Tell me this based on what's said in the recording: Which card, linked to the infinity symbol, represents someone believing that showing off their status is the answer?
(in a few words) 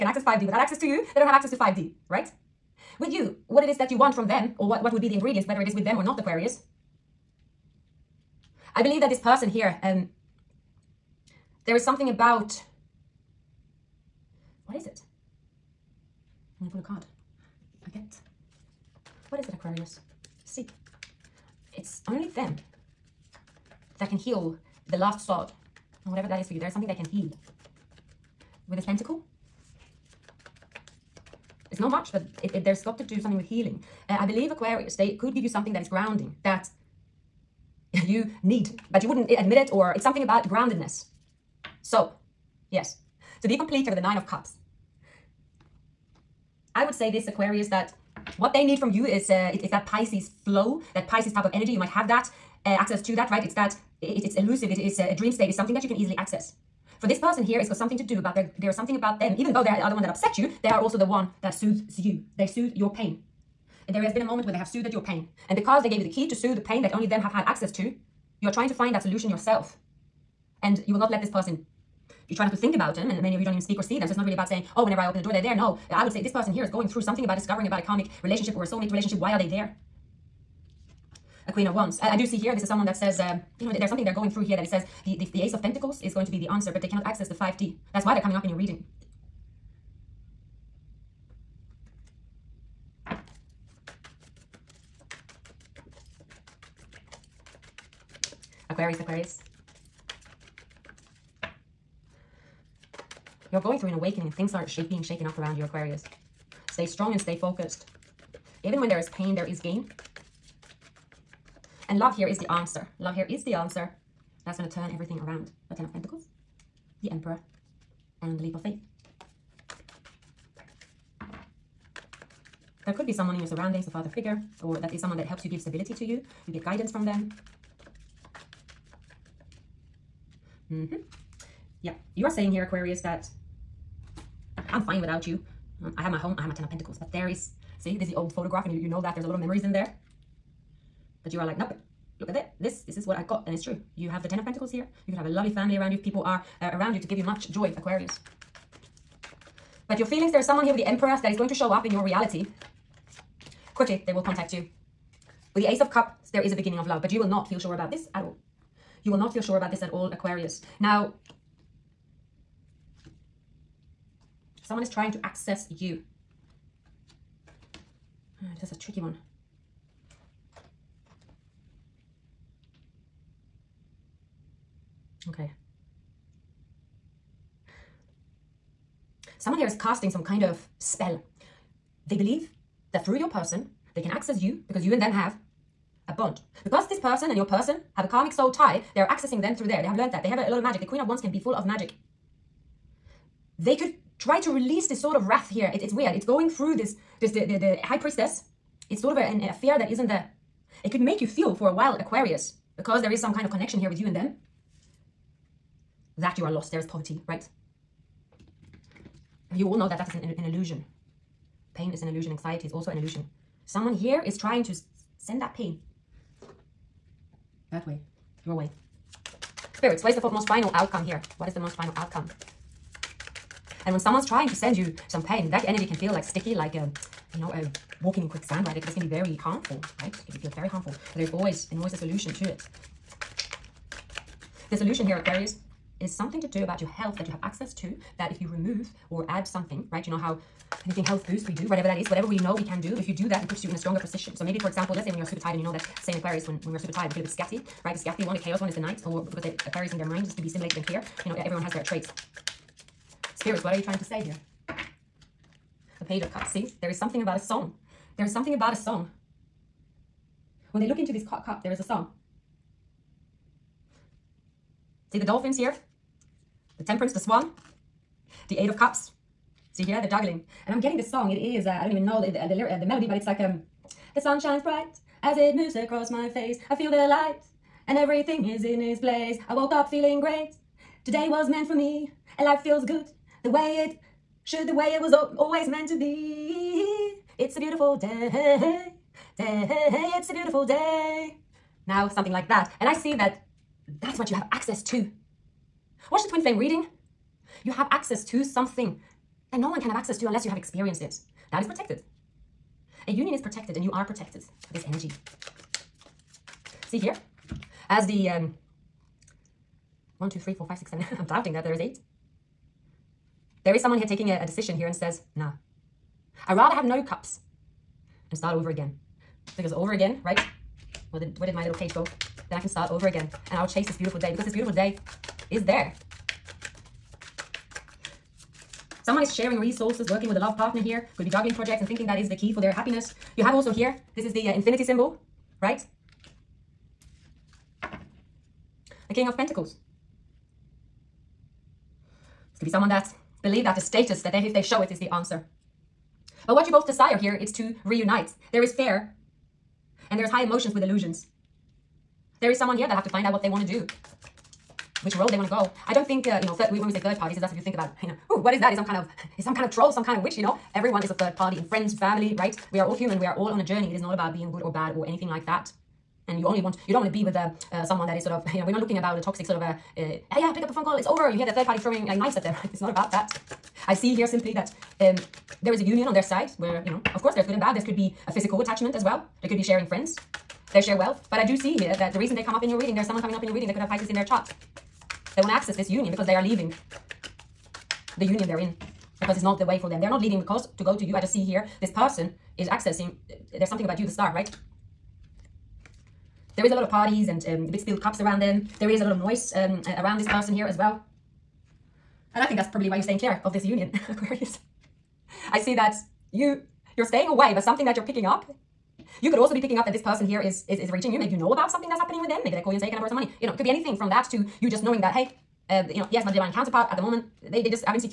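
King of Pentacles.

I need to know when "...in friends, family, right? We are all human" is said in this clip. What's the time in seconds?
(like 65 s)
361 s.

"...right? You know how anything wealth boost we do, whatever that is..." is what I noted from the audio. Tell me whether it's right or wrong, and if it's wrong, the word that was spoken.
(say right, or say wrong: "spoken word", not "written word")
wrong: "health", not "wealth".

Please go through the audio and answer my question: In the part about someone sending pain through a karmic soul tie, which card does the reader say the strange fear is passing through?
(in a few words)
The High Priestess.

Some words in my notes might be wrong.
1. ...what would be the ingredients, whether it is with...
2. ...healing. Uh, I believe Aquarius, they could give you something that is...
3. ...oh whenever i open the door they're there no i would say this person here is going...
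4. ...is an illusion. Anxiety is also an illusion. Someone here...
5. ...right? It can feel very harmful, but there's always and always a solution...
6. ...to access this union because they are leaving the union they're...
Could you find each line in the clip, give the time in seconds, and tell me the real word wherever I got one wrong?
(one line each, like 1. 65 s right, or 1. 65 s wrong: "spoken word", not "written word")
1. 4 s right
2. 33 s right
3. 74 s right
4. 211 s right
5. 230 s right
6. 385 s right.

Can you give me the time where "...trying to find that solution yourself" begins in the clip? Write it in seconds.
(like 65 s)
68 s.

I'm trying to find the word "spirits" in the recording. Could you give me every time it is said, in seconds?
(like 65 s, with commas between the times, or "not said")
219 s, 253 s.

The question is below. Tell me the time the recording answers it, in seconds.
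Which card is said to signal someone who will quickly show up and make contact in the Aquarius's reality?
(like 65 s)
150 s.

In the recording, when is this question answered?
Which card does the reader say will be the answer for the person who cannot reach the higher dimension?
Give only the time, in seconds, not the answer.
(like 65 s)
85 s.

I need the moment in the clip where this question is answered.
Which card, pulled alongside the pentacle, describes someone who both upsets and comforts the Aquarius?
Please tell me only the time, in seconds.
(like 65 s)
43 s.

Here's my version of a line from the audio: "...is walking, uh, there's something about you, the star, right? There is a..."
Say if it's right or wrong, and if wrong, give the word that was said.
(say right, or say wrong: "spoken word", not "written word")
wrong: "accessing", not "walking".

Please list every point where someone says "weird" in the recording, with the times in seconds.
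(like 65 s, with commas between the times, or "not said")
195 s.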